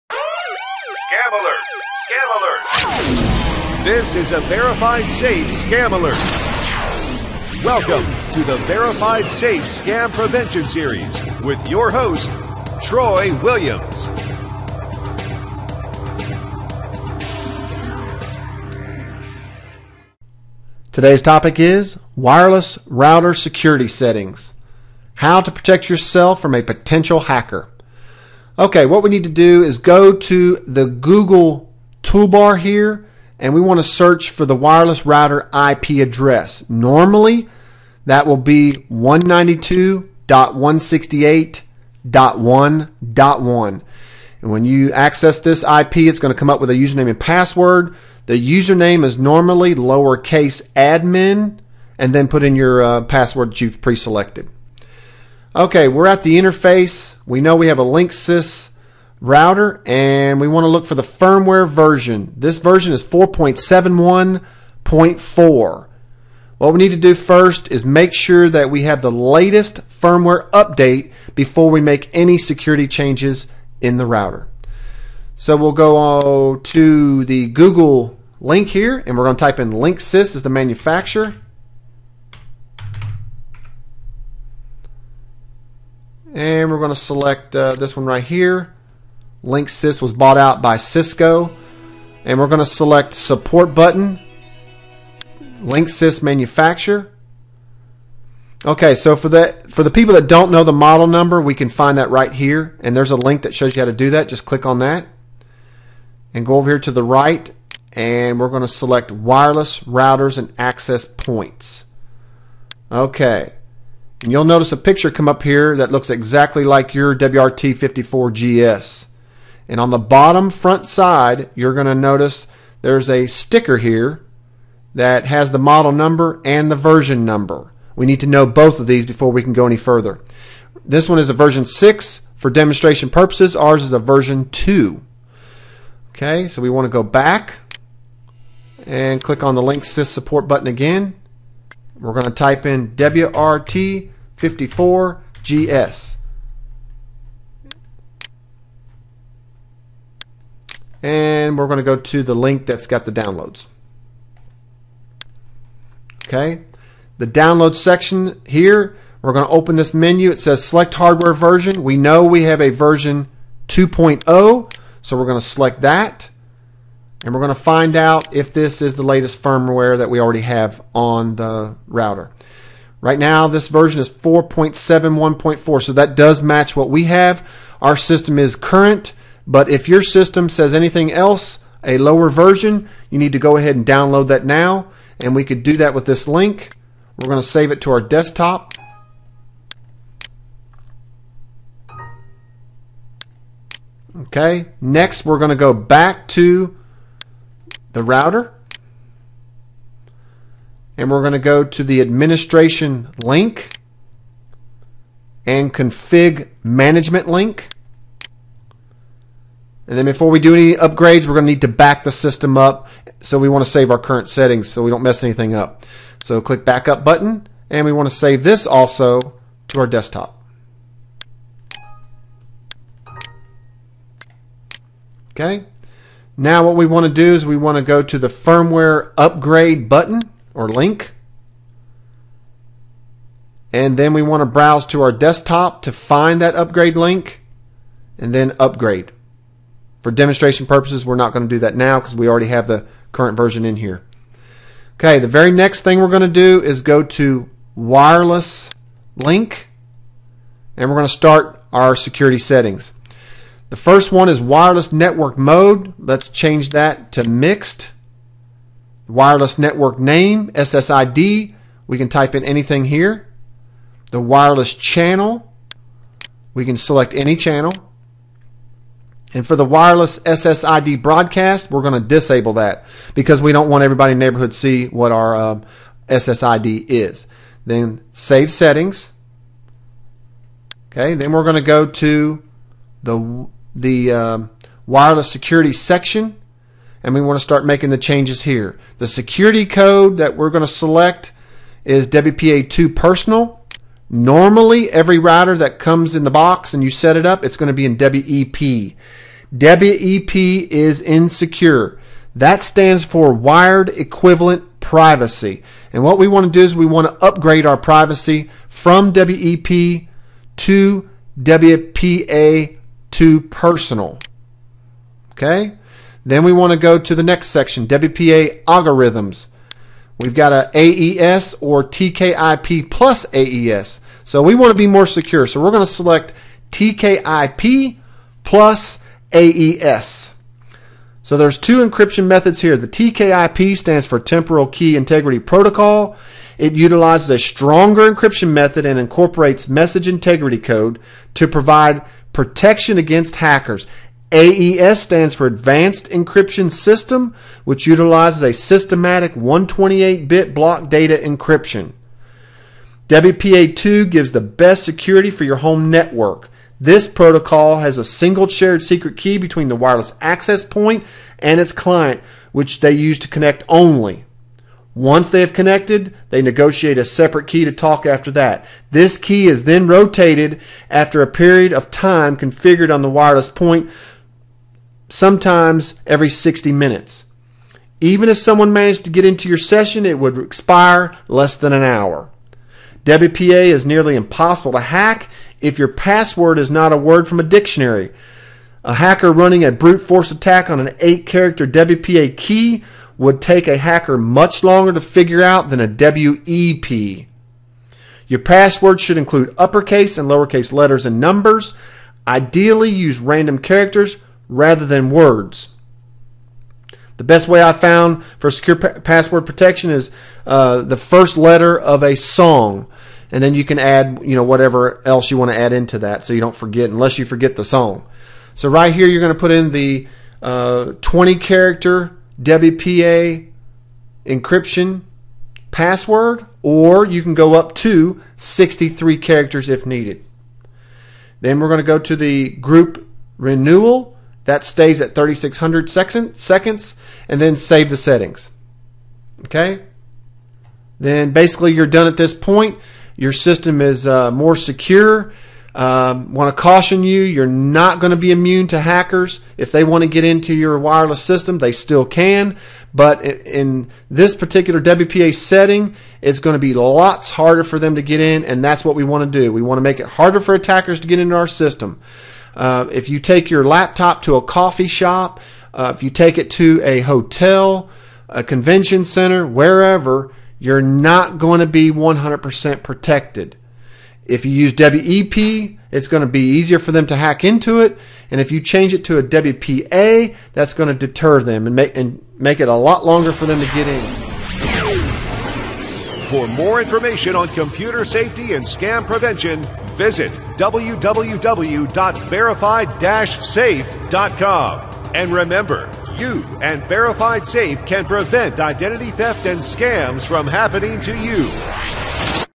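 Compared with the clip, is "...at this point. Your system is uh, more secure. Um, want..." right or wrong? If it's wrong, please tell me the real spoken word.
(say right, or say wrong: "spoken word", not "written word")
right.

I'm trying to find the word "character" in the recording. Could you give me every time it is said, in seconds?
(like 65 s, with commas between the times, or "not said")
391 s, 403 s, 421 s, 429 s.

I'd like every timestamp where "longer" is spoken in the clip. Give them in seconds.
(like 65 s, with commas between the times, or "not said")
394 s, 483 s.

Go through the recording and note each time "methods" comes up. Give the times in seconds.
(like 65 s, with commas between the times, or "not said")
332 s, 338 s.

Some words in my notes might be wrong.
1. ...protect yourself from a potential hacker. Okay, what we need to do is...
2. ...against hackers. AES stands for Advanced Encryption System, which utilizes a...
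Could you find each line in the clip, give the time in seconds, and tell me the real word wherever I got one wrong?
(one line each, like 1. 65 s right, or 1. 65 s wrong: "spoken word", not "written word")
1. 25 s right
2. 342 s right.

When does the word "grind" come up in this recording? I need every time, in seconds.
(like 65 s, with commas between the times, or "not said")
not said.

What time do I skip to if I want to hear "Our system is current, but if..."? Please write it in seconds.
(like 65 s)
177 s.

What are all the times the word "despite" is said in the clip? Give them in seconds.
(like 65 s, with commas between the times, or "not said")
not said.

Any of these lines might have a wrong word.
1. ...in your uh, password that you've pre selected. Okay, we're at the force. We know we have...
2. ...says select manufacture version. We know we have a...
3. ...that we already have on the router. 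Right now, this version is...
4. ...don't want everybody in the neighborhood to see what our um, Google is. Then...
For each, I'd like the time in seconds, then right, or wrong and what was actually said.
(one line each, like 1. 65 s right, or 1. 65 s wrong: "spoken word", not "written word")
1. 52 s wrong: "interface", not "force"
2. 160 s wrong: "hardware", not "manufacture"
3. 169 s right
4. 273 s wrong: "SSID", not "Google".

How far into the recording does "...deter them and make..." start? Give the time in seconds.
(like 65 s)
480 s.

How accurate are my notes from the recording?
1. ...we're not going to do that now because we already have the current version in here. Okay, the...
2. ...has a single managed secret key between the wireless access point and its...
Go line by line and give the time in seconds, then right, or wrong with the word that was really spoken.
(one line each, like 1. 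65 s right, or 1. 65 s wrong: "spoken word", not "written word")
1. 241 s right
2. 357 s wrong: "shared", not "managed".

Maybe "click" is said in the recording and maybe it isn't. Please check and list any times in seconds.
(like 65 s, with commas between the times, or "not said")
104 s, 139 s, 216 s.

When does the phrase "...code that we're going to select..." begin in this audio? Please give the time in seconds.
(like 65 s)
289 s.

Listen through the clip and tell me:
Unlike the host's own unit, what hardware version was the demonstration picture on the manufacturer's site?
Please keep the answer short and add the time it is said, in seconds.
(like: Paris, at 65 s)
version 6, at 131 s.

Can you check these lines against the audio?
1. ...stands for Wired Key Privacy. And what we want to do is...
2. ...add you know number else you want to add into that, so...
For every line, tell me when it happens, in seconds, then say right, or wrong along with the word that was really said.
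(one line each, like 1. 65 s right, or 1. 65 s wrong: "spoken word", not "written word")
1. 302 s wrong: "Equivalent", not "Key"
2. 413 s wrong: "whatever", not "number".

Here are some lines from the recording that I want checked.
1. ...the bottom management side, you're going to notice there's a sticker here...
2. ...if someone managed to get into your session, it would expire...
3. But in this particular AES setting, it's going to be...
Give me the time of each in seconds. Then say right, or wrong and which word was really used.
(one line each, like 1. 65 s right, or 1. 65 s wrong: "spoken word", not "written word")
1. 119 s wrong: "front", not "management"
2. 378 s right
3. 452 s wrong: "WPA", not "AES".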